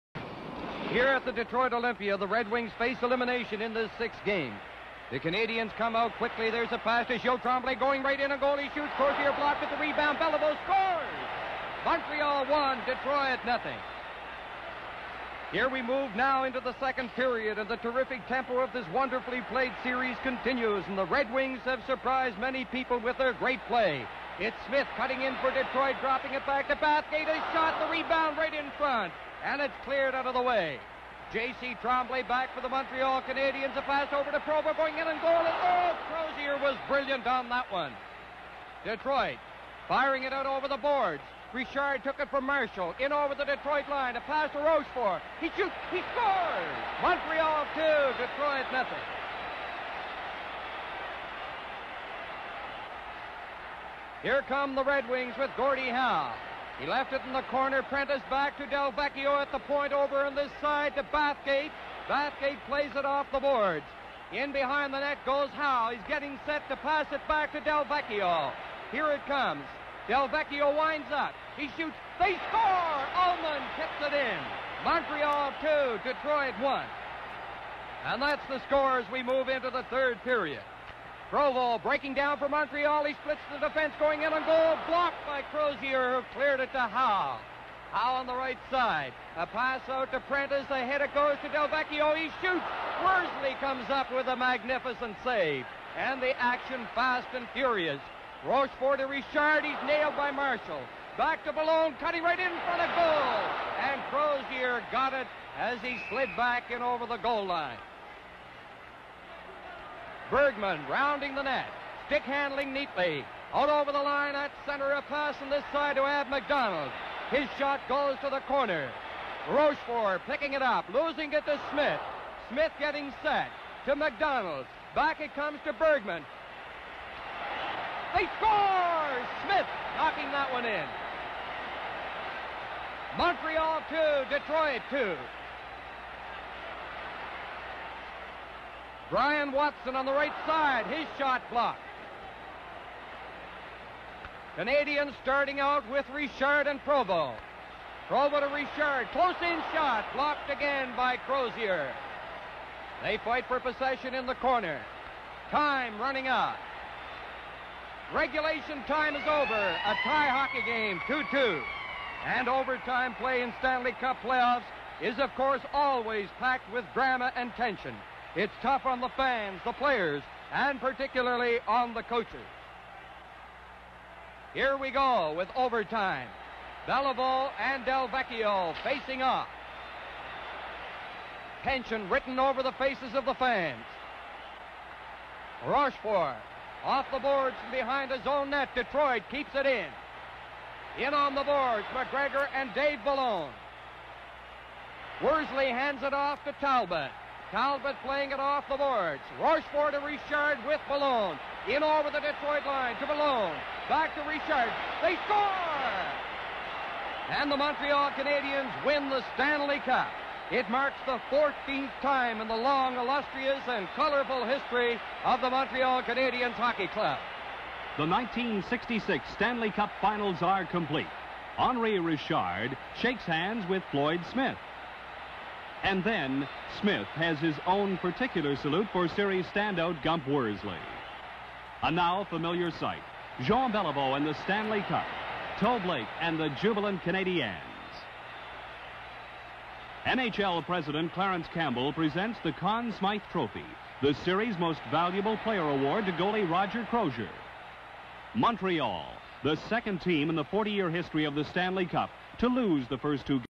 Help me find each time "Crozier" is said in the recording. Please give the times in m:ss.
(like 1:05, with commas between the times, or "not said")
0:08, 0:36, 1:25, 1:44, 2:31, 4:06.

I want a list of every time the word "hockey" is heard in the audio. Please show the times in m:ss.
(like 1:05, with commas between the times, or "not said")
2:40, 3:36.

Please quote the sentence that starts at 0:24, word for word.
It's Smith cutting in for Detroit, dropping it back to Bathgate.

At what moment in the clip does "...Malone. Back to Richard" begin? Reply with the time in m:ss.
3:23.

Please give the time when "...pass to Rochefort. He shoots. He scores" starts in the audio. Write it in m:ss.
0:44.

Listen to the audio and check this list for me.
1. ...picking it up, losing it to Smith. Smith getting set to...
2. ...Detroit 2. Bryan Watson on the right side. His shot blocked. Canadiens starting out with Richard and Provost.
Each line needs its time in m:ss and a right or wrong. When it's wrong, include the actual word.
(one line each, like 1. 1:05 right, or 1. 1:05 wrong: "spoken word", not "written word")
1. 2:00 right
2. 2:14 right.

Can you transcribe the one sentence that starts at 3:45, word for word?
And then Smith has his own particular salute for series standout Gump Worsley.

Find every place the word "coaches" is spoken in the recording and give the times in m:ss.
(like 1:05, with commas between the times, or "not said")
2:52.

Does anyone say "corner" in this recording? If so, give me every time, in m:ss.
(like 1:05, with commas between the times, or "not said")
0:57, 1:58, 2:34.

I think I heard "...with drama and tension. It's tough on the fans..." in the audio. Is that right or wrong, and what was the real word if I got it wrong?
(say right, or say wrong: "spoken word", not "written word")
right.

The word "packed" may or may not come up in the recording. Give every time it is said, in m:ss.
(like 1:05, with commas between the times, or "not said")
2:46.